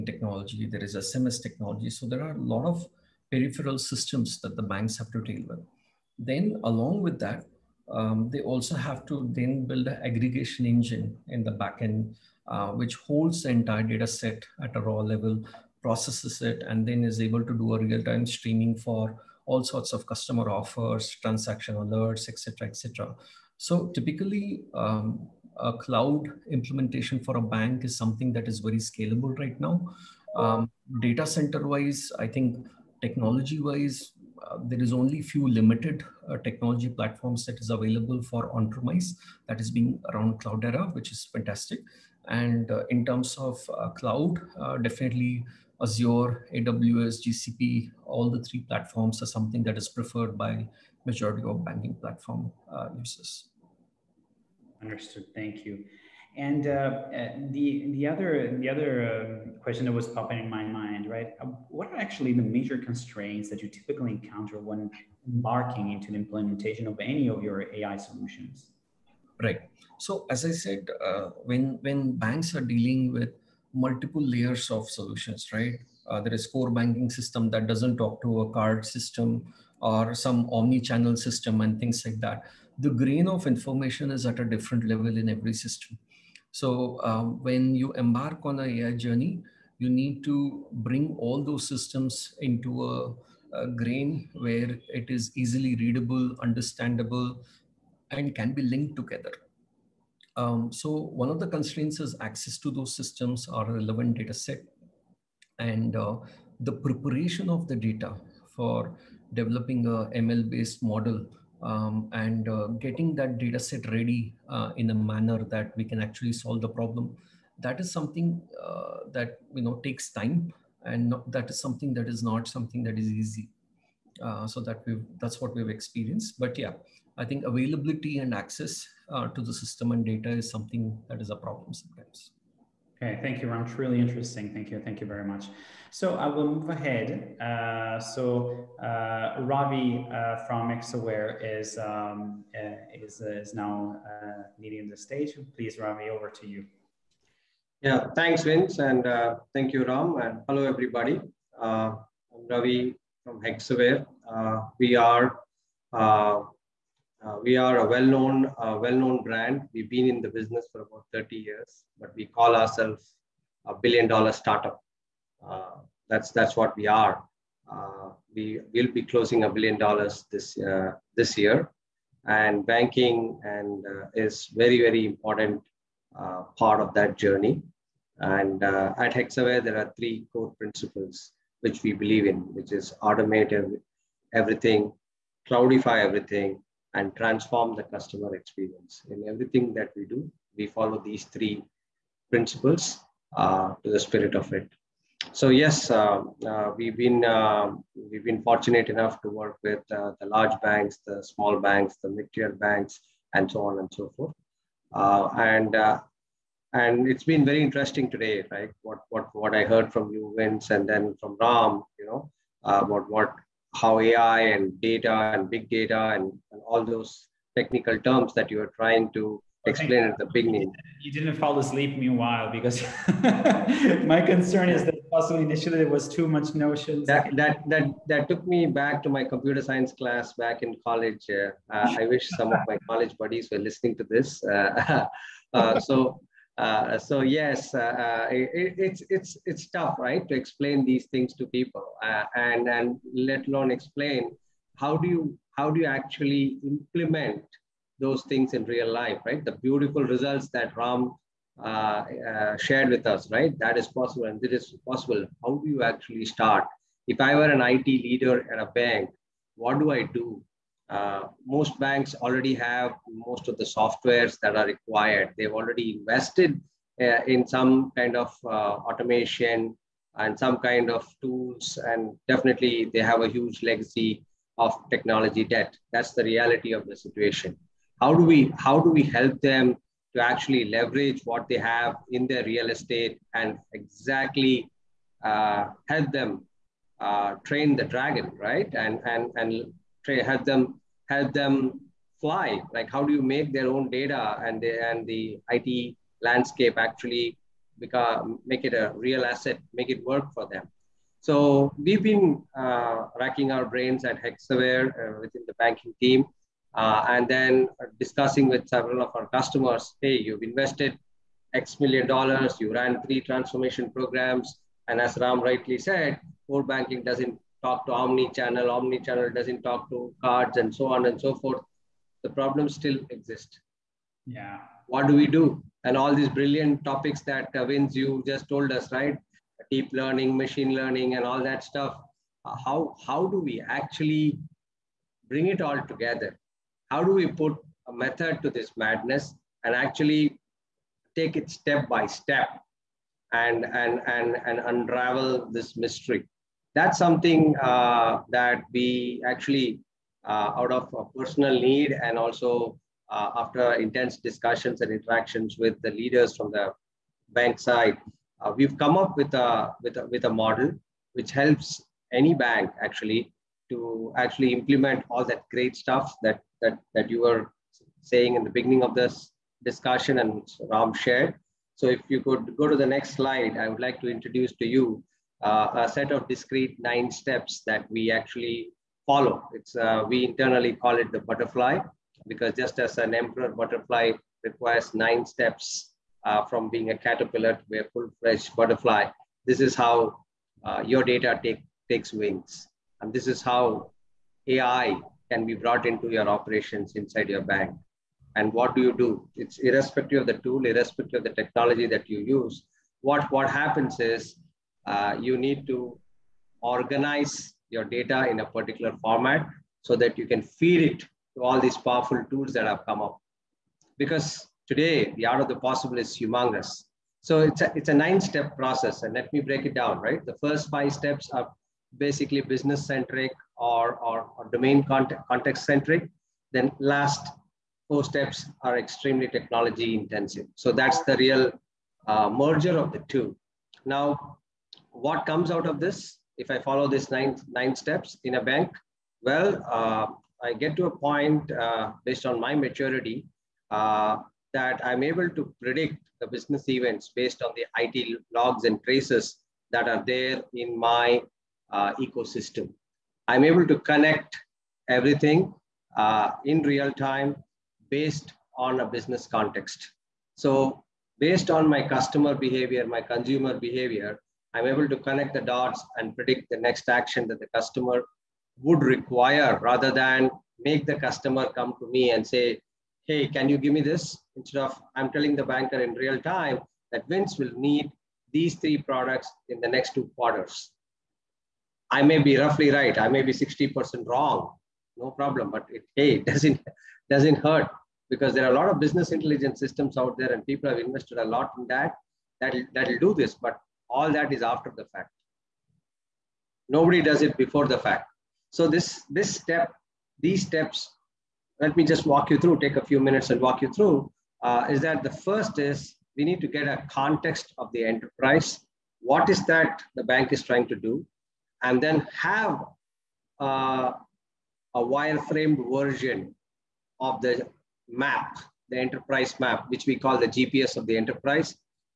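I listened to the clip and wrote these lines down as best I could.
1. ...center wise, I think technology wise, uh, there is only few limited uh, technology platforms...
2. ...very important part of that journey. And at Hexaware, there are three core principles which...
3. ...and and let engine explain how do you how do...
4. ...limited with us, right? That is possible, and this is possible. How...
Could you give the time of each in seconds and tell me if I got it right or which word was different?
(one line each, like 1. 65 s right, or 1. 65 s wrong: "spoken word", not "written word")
1. 31 s right
2. 174 s right
3. 242 s wrong: "alone", not "engine"
4. 252 s wrong: "shared", not "limited".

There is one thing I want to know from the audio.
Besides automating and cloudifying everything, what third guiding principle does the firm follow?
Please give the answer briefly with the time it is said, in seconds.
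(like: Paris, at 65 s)
transform the customer experience, at 187 s.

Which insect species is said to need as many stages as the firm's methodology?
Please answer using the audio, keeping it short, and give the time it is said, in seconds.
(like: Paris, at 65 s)
emperor butterfly, at 383 s.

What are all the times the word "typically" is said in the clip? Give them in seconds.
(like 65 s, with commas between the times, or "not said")
23 s, 63 s.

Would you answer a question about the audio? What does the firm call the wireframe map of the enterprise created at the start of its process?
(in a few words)
GPS of the enterprise.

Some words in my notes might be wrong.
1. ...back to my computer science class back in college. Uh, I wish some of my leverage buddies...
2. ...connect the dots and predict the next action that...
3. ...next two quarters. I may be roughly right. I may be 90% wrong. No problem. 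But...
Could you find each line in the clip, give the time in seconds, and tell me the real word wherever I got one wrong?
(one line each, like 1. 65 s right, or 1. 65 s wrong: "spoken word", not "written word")
1. 228 s wrong: "college", not "leverage"
2. 464 s right
3. 479 s wrong: "60", not "90".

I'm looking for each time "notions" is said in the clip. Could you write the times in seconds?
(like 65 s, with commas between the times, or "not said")
226 s.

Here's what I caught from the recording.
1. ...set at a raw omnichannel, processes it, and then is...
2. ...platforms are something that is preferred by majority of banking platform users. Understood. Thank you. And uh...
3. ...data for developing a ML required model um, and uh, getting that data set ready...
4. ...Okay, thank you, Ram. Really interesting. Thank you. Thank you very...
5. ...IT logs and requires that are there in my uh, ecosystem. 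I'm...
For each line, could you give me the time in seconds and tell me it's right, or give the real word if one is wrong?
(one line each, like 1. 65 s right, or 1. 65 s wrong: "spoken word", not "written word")
1. 14 s wrong: "level", not "omnichannel"
2. 48 s right
3. 107 s wrong: "based", not "required"
4. 133 s right
5. 447 s wrong: "traces", not "requires".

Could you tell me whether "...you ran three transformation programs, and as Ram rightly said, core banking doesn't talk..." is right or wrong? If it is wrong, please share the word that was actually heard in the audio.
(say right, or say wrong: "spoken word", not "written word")
right.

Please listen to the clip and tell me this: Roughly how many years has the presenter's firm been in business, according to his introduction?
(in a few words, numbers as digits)
30.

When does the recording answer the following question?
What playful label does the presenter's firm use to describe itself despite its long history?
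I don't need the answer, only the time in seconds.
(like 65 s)
163 s.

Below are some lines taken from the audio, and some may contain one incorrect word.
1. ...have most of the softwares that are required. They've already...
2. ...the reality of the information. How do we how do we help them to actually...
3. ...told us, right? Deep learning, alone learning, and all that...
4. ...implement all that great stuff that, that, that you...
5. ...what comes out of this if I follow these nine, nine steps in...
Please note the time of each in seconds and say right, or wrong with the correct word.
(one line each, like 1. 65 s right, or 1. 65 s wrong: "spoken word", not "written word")
1. 262 s right
2. 276 s wrong: "situation", not "information"
3. 328 s wrong: "machine", not "alone"
4. 364 s right
5. 435 s right.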